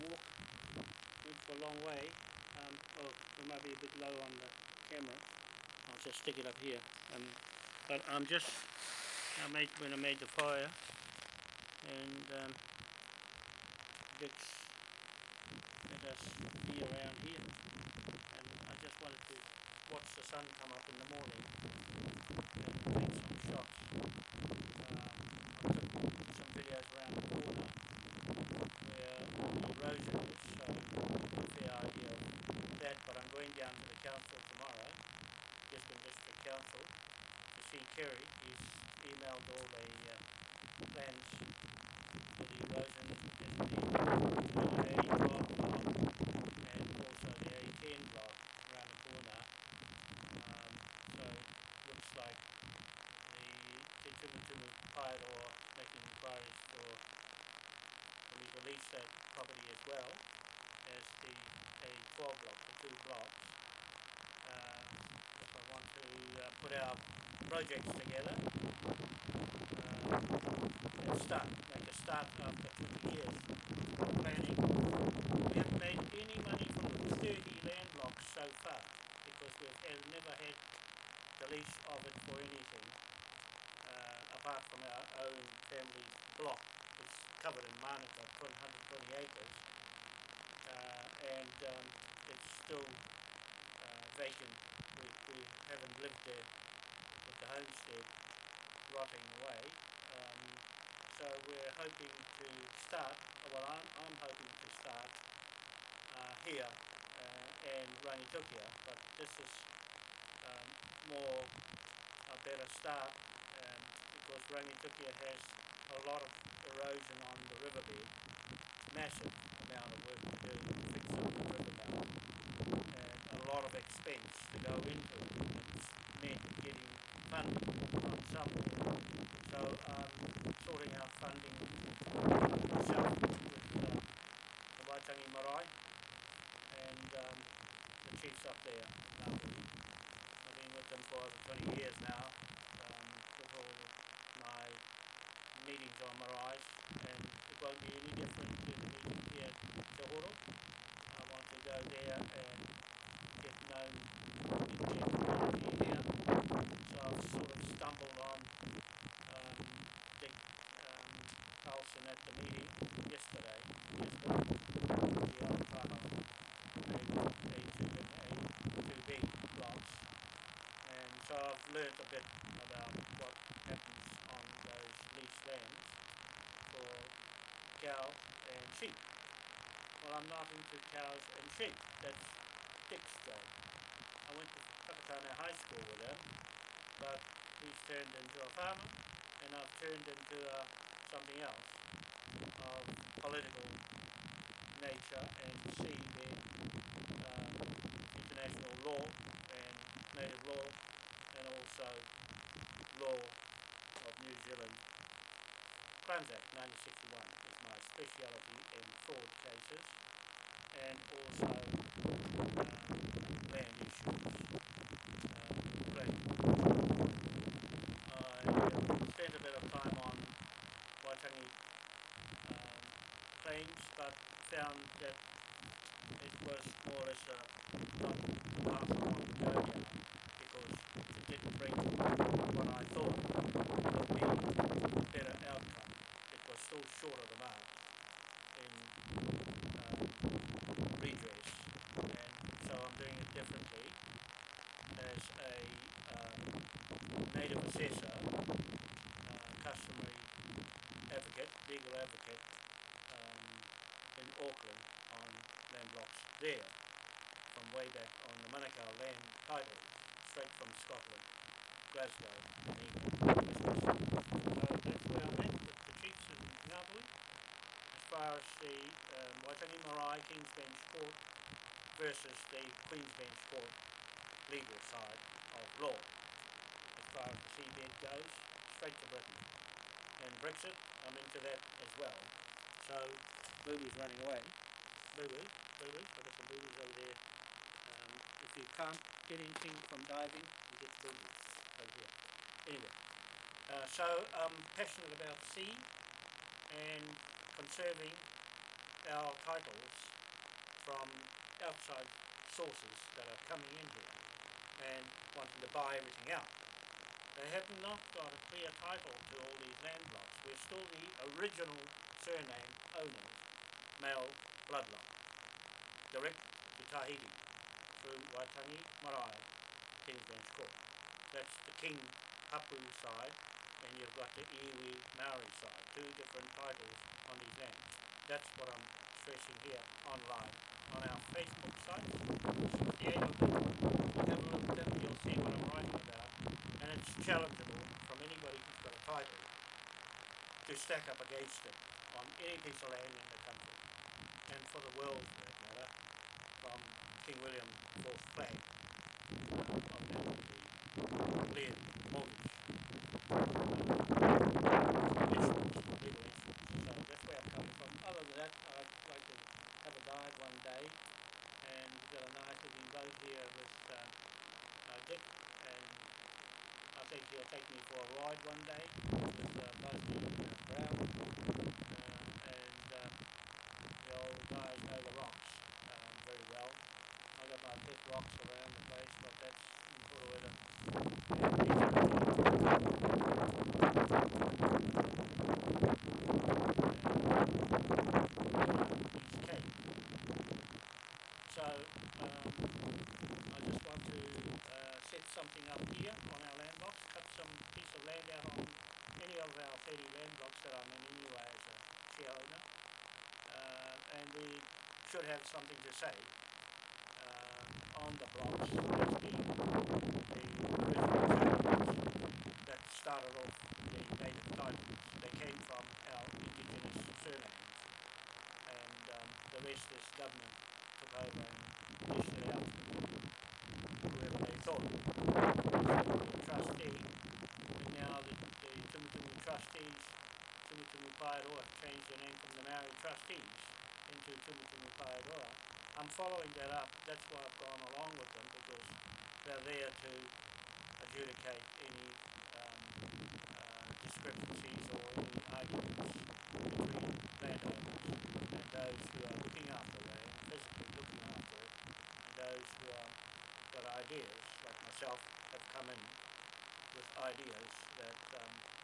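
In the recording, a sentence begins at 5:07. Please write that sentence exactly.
They have not got a clear title to all these land blocks.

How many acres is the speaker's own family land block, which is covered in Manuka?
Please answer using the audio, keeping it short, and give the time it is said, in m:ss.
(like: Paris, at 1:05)
120, at 1:28.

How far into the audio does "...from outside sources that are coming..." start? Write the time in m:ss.
5:00.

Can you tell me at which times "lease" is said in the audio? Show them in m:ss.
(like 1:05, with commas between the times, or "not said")
0:58, 1:21.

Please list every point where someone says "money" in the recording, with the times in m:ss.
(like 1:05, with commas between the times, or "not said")
1:16.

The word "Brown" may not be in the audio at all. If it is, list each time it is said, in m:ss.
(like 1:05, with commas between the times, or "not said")
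6:09.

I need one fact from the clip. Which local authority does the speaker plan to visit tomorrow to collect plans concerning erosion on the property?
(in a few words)
Gisborne District Council.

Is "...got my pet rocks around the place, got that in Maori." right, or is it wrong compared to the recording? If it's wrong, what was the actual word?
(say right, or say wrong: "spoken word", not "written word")
wrong: "Purueta", not "Maori".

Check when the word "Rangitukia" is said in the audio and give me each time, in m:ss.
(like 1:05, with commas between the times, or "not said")
1:48, 1:54.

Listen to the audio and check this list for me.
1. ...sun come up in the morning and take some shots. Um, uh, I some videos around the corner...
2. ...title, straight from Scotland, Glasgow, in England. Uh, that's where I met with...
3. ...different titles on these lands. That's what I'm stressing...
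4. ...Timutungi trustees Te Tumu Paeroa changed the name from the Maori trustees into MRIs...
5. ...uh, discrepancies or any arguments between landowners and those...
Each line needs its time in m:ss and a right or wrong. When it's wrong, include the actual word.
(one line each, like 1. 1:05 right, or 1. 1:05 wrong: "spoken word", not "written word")
1. 0:20 right
2. 4:19 right
3. 5:26 right
4. 7:08 wrong: "Timutungi", not "MRIs"
5. 7:23 right.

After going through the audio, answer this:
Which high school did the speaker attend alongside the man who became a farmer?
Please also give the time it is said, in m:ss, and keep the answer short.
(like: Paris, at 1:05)
Takatana High School, at 3:04.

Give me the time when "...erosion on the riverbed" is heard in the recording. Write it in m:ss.
1:56.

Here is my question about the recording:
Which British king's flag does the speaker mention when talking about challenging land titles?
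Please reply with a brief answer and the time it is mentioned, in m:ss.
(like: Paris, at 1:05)
King William IV, at 5:47.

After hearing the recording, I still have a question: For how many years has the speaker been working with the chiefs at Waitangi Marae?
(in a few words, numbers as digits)
over 20.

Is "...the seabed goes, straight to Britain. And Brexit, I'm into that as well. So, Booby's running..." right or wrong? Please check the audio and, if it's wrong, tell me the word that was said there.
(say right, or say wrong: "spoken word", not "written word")
right.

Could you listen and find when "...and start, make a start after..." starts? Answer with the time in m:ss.
1:11.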